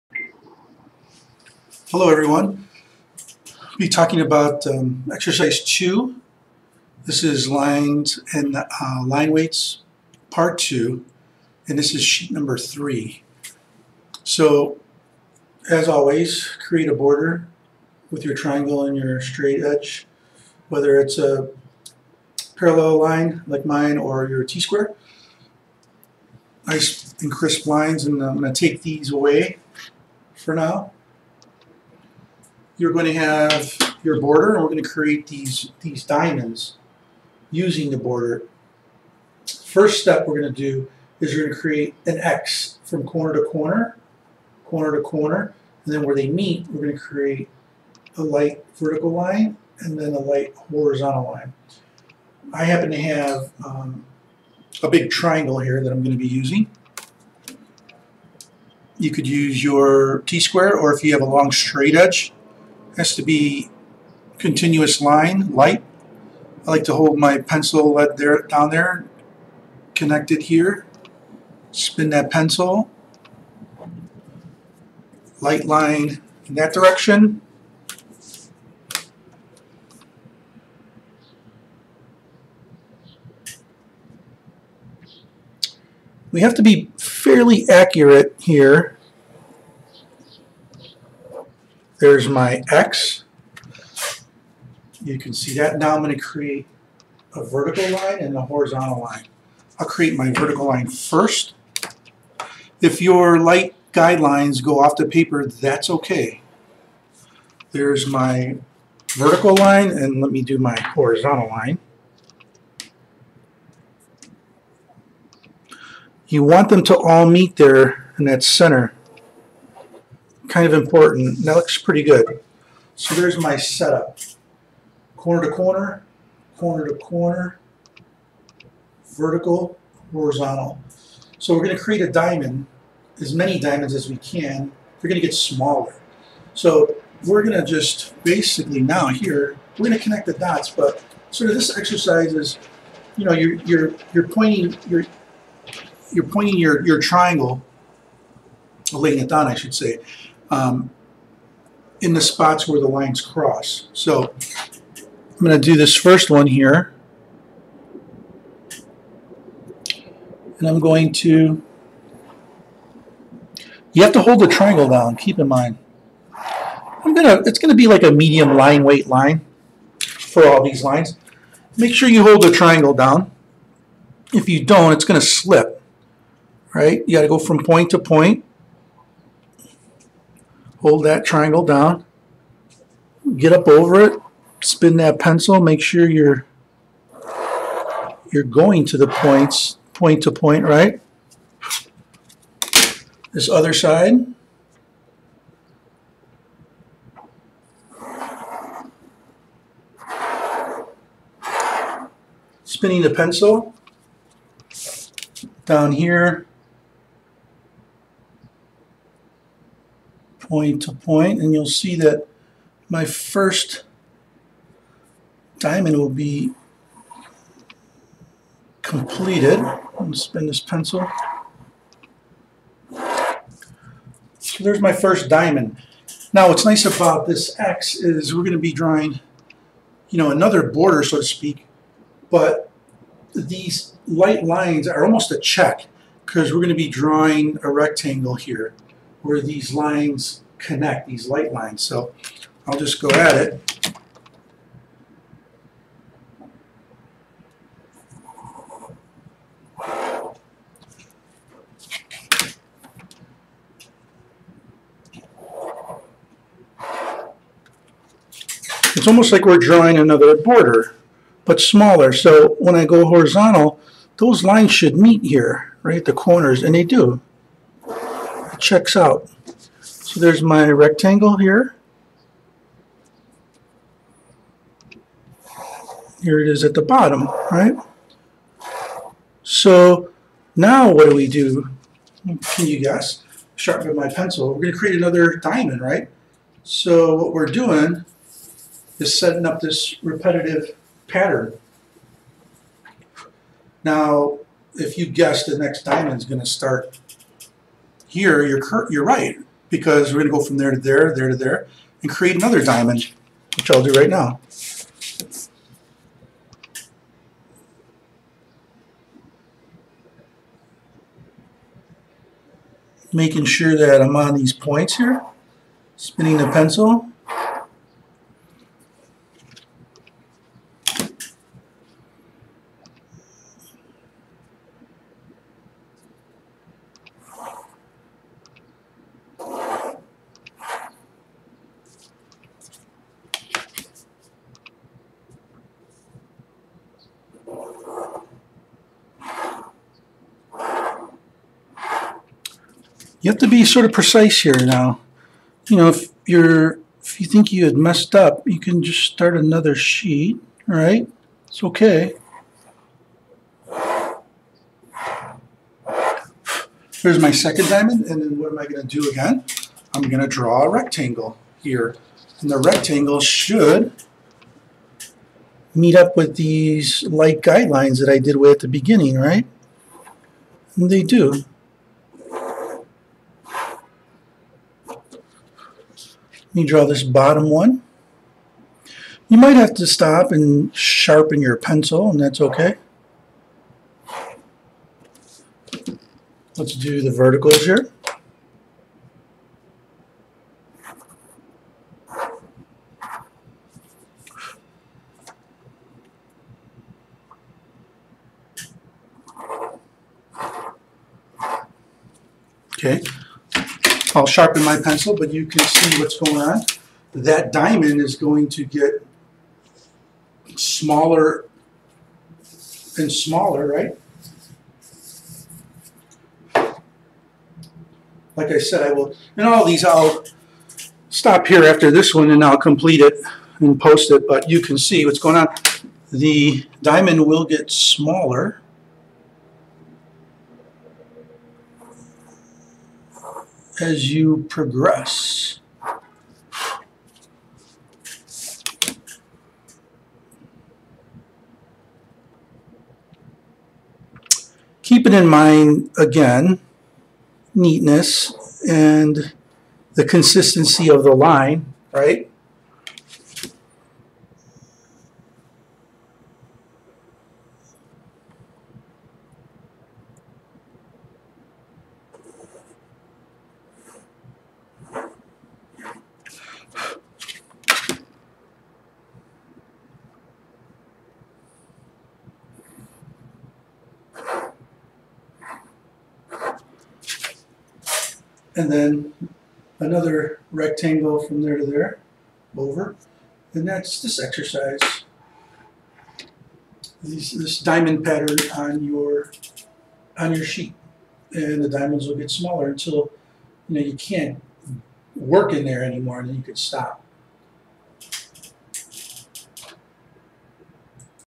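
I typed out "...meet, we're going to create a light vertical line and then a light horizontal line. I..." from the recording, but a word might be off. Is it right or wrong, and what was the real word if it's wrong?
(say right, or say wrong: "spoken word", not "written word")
right.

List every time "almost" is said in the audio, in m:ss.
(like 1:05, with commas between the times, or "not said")
3:55, 4:19.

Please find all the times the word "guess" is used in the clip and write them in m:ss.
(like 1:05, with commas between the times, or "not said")
4:42, 4:55.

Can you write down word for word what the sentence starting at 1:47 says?
There's my vertical line, and let me do my horizontal line.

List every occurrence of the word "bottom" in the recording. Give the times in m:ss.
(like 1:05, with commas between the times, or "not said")
4:36, 6:17.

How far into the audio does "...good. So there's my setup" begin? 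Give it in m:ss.
2:02.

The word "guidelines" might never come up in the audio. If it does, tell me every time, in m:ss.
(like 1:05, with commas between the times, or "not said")
1:43, 6:07.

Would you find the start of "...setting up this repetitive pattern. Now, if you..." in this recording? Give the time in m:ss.
4:49.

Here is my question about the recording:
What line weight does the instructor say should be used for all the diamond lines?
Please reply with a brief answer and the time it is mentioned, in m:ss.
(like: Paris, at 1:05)
Medium, at 2:48.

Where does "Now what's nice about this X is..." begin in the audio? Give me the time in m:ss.
3:46.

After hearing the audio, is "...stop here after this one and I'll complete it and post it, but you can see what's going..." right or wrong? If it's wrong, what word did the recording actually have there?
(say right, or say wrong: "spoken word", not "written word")
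right.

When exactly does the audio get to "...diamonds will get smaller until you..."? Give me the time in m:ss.
8:11.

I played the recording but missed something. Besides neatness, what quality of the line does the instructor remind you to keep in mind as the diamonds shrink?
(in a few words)
Consistency.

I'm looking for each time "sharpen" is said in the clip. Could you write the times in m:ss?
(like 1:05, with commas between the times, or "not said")
4:43, 6:20, 6:44.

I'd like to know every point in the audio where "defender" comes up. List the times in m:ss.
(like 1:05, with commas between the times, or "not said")
not said.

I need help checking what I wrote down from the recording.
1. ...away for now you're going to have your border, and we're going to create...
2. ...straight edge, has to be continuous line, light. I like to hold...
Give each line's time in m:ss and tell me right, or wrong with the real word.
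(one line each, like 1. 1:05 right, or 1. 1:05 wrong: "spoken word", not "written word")
1. 0:29 right
2. 1:01 right.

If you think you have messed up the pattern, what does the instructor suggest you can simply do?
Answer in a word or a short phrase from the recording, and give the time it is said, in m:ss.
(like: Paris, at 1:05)
Start another sheet, at 5:49.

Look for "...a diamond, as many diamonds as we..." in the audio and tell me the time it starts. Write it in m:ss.
2:12.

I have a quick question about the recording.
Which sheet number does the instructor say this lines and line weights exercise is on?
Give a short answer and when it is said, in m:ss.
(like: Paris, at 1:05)
3, at 0:12.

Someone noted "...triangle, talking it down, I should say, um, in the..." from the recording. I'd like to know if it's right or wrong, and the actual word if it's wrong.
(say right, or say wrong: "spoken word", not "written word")
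wrong: "laying", not "talking".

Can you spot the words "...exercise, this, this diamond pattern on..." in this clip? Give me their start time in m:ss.
8:04.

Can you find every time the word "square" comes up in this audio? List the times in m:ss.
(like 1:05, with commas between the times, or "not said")
0:24, 1:00.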